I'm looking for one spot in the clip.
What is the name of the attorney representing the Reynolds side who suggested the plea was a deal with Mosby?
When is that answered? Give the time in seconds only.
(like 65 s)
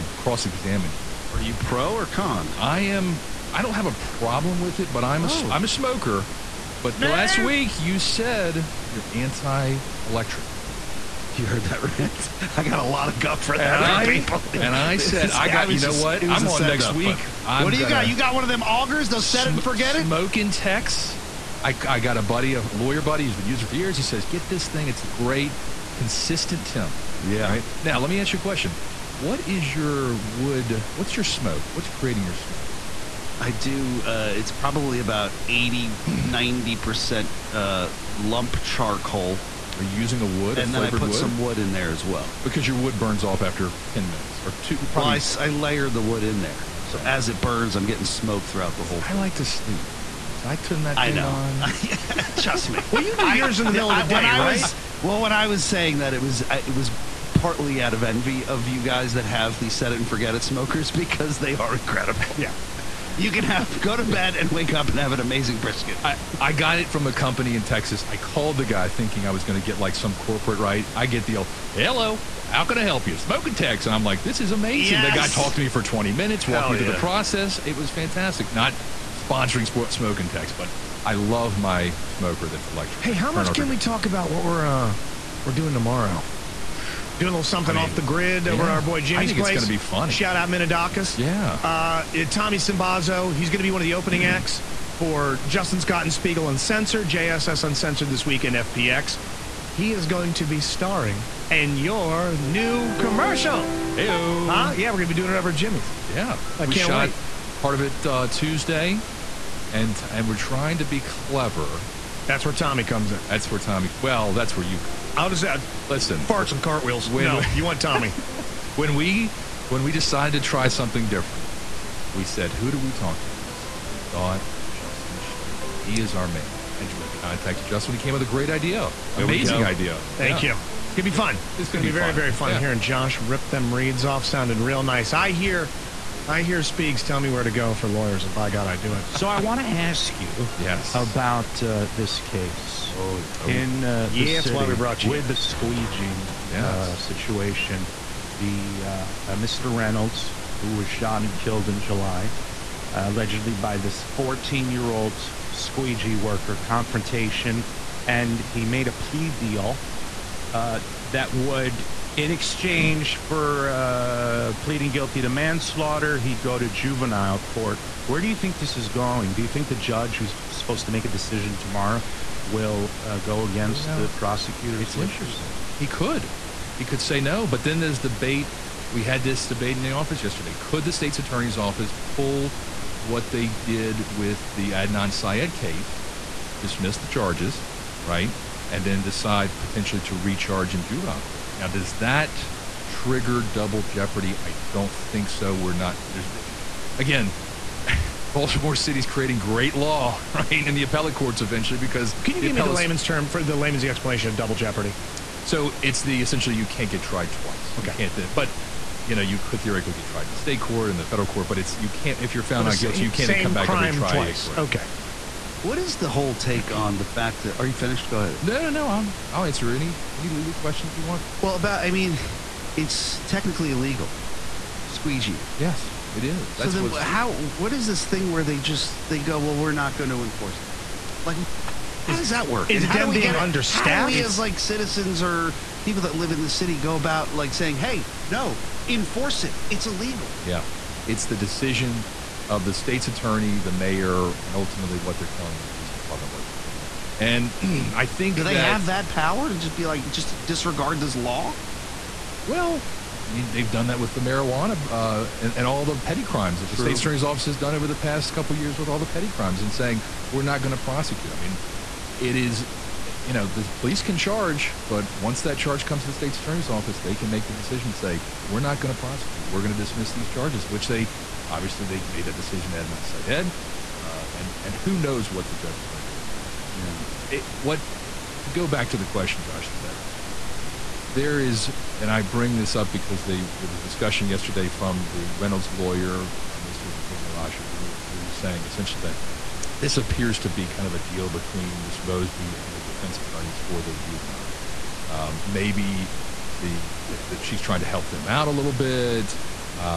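287 s.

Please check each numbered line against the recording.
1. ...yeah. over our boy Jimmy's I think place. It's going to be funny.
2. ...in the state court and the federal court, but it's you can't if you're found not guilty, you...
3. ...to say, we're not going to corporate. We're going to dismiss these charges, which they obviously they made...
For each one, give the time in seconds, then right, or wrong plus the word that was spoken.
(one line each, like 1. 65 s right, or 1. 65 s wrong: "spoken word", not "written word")
1. 88 s right
2. 210 s right
3. 267 s wrong: "prosecute", not "corporate".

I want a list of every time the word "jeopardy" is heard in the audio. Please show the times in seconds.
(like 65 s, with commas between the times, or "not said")
193 s, 204 s.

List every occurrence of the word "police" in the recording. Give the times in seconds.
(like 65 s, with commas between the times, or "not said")
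245 s, 263 s.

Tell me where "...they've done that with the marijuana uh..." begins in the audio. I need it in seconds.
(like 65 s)
253 s.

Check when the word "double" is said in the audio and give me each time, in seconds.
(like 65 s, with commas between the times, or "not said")
193 s, 204 s.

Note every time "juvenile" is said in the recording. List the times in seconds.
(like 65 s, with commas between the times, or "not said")
166 s, 190 s, 293 s.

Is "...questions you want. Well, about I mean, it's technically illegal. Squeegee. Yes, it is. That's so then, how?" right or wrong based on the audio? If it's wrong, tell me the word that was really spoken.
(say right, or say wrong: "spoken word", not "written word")
right.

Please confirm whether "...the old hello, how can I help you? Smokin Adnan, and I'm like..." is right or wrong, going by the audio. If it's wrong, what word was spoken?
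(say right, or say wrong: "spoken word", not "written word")
wrong: "Tex", not "Adnan".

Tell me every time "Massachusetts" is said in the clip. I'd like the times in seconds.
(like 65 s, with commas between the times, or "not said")
not said.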